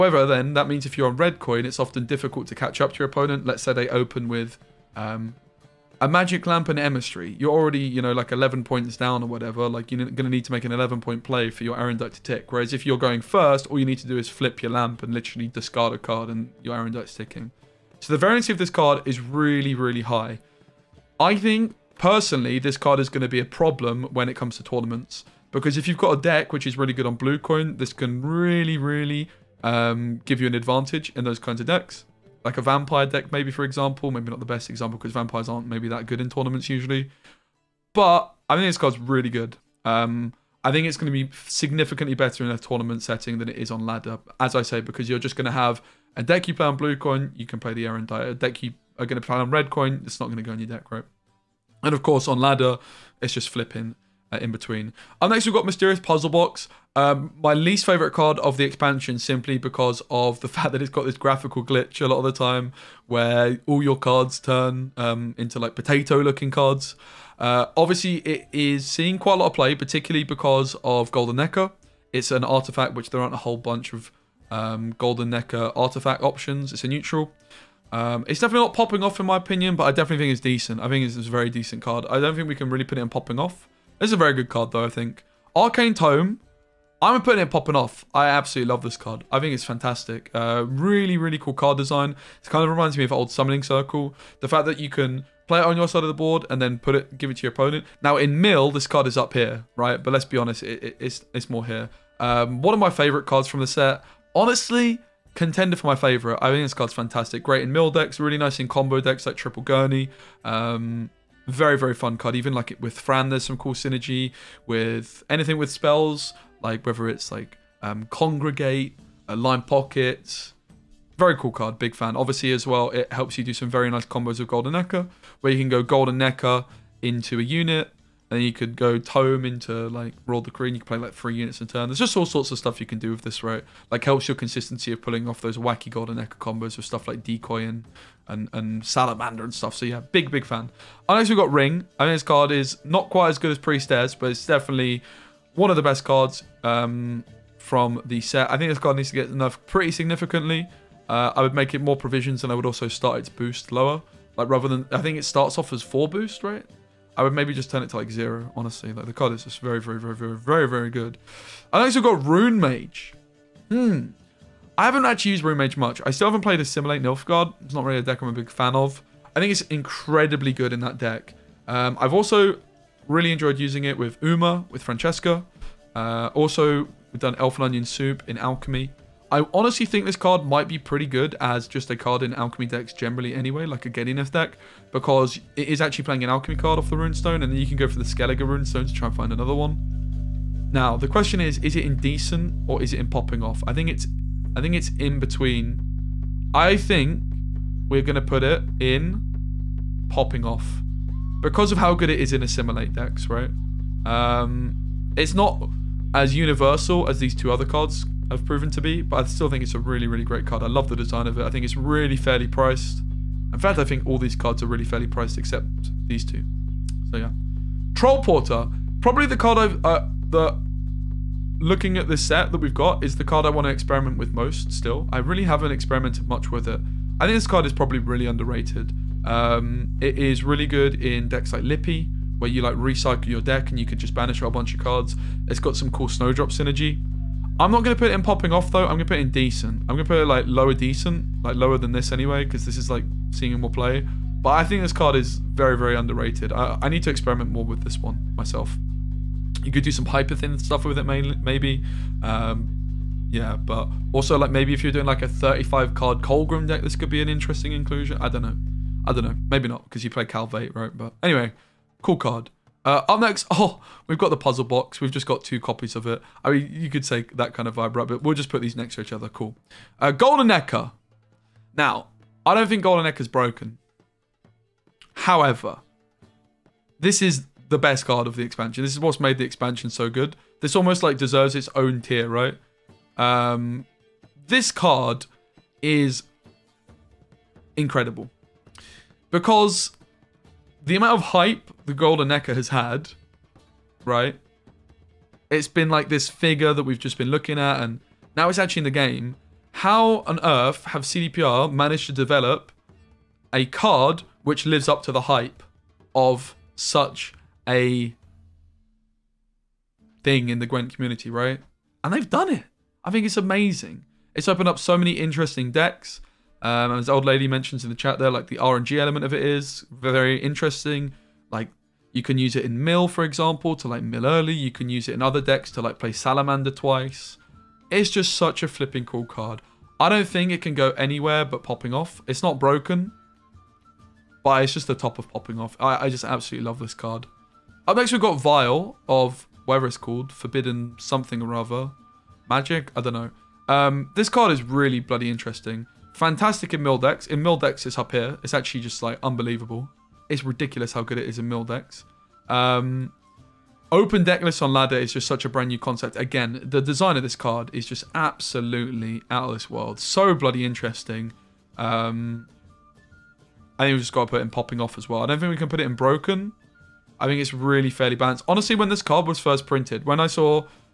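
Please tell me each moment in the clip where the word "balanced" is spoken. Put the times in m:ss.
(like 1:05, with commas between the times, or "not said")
6:08.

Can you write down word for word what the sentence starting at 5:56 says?
Again, the design of this card is just absolutely out of this world.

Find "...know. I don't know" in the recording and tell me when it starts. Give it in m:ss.
4:18.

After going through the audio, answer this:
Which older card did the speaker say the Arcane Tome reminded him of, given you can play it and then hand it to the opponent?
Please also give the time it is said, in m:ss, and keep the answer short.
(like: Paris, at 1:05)
Summoning Circle, at 1:33.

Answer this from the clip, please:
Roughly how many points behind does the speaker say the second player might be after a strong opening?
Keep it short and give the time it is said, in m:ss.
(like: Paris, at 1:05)
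11, at 0:08.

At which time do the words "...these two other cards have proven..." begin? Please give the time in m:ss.
3:27.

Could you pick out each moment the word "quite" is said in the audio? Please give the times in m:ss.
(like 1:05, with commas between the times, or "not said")
1:09, 2:23.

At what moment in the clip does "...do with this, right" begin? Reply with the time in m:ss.
2:12.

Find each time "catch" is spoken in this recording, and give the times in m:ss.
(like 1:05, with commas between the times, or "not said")
0:02.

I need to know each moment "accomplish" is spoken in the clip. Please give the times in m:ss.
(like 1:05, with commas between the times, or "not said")
not said.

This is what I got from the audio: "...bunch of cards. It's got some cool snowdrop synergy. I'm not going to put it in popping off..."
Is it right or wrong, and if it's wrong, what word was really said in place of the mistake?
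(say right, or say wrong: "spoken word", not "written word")
right.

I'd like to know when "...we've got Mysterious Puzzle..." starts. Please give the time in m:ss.
0:55.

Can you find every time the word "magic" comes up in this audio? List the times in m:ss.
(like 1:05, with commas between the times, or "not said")
0:06, 5:42.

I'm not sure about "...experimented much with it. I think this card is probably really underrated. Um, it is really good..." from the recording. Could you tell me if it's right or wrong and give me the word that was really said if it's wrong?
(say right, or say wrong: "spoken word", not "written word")
right.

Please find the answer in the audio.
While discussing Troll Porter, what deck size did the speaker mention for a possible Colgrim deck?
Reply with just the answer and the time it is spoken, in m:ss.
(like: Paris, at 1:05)
35, at 4:15.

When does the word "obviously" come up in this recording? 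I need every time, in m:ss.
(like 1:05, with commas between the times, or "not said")
1:07, 2:02.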